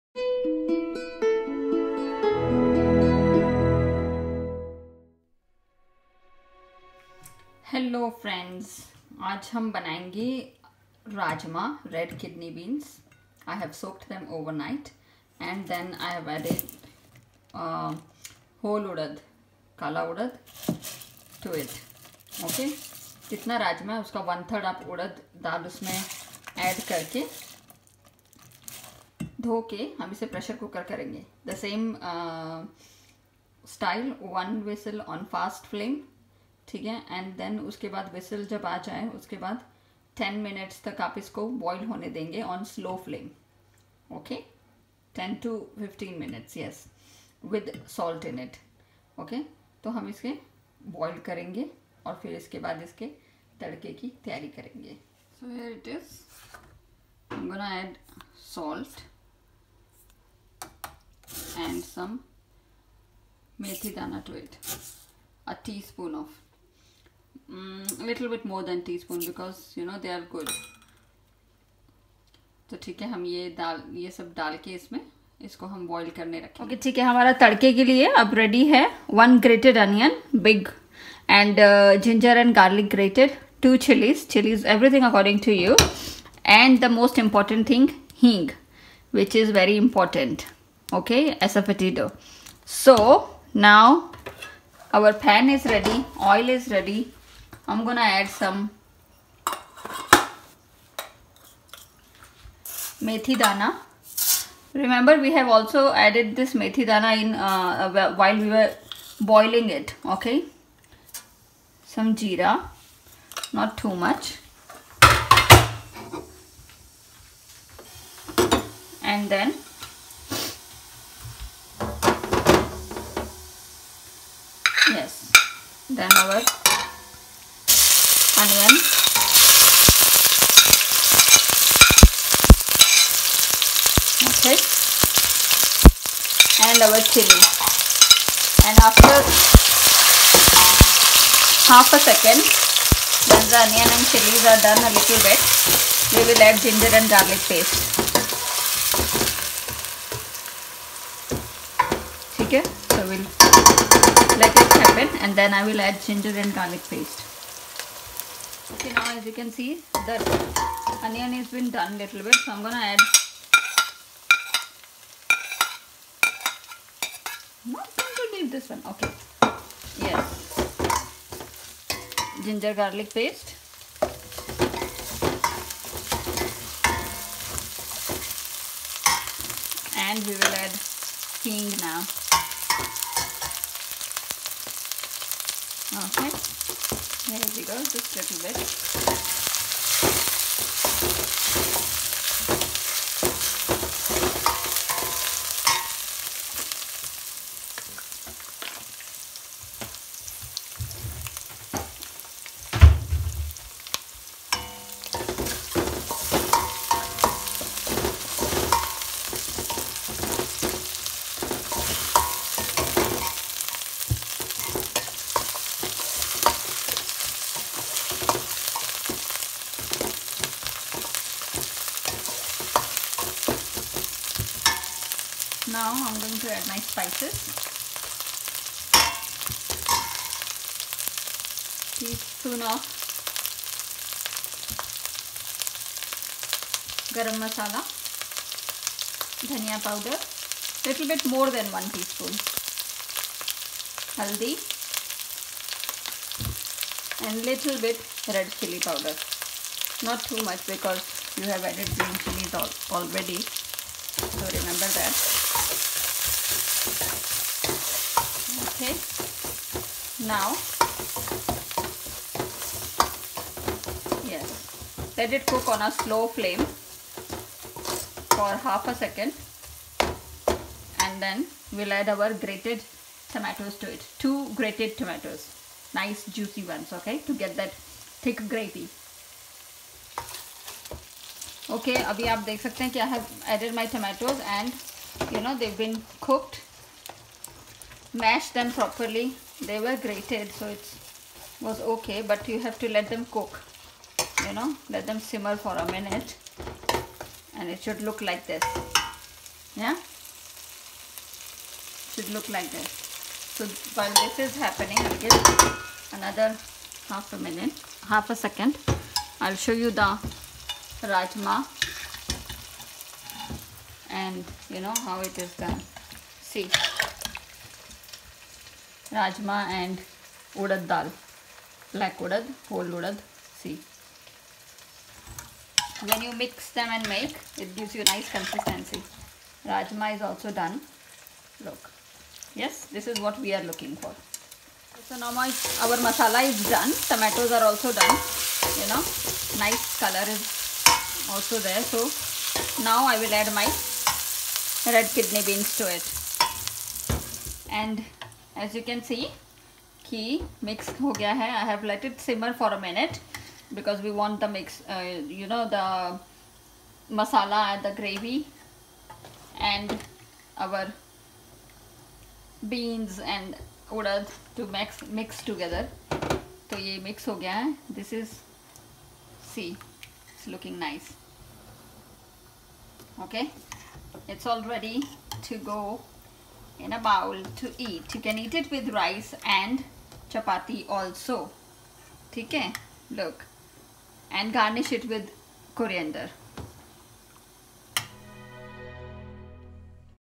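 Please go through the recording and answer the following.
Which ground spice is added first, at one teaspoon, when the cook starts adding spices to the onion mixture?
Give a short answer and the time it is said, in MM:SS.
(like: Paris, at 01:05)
garam masala, at 03:57.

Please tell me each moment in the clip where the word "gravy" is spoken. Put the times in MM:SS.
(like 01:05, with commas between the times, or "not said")
04:38, 05:58.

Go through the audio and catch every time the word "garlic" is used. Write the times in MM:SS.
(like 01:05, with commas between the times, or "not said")
02:27, 02:36, 02:52.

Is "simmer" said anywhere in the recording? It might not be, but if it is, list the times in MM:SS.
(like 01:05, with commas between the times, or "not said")
04:55, 05:52.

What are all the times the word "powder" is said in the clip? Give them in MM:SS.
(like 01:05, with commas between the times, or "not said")
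03:59, 04:08.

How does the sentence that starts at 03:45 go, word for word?
Now I'm going to add my spices.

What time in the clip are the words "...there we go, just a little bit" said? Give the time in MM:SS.
03:07.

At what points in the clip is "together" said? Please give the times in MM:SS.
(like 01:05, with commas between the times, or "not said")
06:05.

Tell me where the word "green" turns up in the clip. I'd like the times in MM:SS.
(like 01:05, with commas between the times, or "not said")
04:11.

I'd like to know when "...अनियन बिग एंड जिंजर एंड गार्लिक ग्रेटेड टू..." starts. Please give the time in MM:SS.
01:19.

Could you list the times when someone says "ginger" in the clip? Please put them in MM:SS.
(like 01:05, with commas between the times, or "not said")
02:26, 02:36, 02:52.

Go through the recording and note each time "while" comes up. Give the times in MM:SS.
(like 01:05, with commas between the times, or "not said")
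01:48, 05:04.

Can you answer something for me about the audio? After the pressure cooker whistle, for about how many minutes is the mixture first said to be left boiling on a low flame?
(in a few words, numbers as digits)
10 minutes.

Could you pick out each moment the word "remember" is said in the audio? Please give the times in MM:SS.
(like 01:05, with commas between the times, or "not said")
01:44, 04:14.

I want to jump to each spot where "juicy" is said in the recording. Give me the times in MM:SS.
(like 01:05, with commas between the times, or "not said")
04:36.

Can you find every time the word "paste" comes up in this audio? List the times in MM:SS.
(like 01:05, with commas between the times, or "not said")
02:27, 02:36, 02:53.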